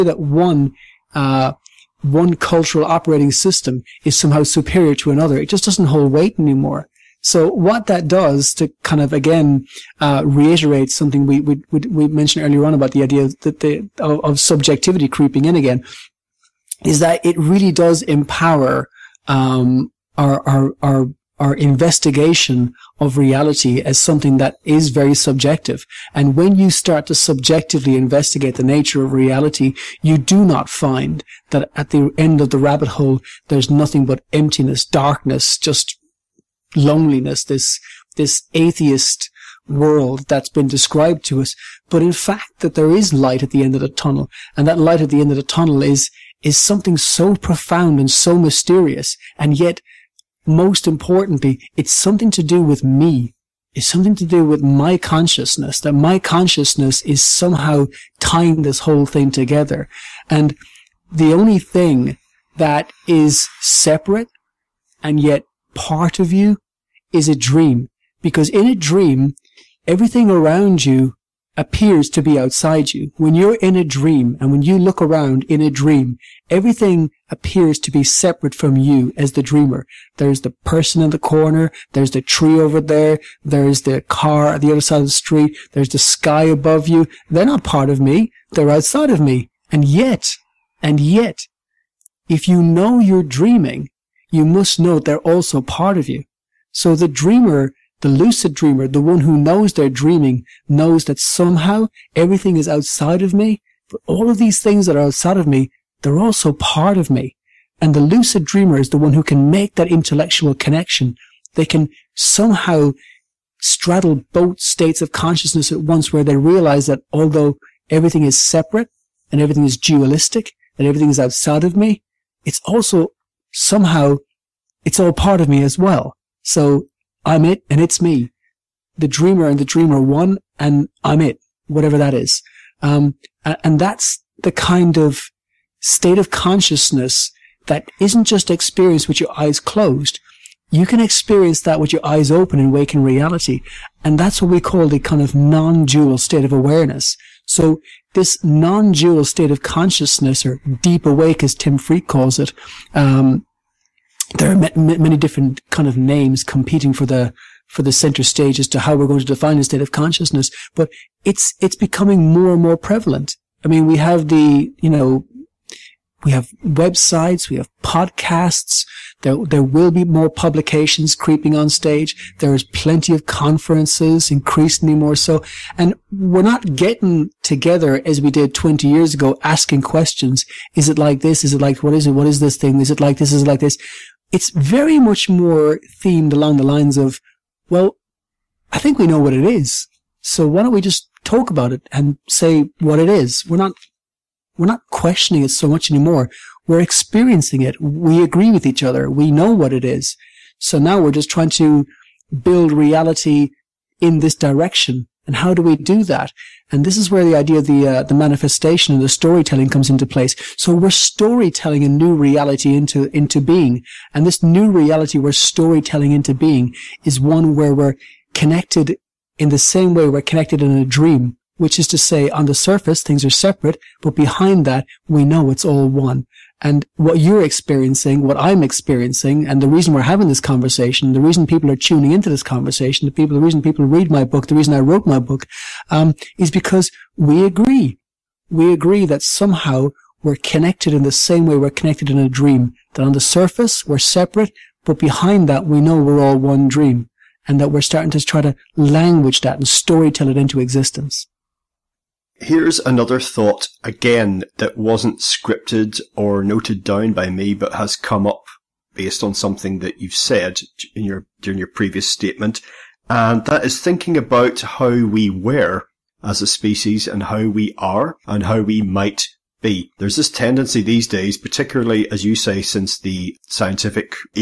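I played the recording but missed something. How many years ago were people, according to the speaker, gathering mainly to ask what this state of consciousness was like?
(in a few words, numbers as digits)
20.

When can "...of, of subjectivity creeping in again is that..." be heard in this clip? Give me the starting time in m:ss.
0:13.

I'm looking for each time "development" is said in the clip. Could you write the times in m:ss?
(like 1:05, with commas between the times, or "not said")
not said.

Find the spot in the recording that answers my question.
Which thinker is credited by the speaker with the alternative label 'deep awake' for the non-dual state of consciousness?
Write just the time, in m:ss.
2:31.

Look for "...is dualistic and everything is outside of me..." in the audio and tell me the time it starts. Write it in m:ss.
1:59.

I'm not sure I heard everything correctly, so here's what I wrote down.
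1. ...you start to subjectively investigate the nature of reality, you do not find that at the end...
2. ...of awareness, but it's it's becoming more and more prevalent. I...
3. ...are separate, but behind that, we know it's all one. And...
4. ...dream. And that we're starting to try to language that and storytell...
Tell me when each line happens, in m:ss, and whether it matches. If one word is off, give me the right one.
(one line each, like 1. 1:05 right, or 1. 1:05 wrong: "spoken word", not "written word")
1. 0:26 right
2. 2:39 wrong: "consciousness", not "awareness"
3. 3:43 right
4. 4:06 right.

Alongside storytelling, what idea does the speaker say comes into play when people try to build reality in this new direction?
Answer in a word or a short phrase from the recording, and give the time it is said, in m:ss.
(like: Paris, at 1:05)
manifestation, at 3:28.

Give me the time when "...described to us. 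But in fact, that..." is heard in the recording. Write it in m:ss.
0:40.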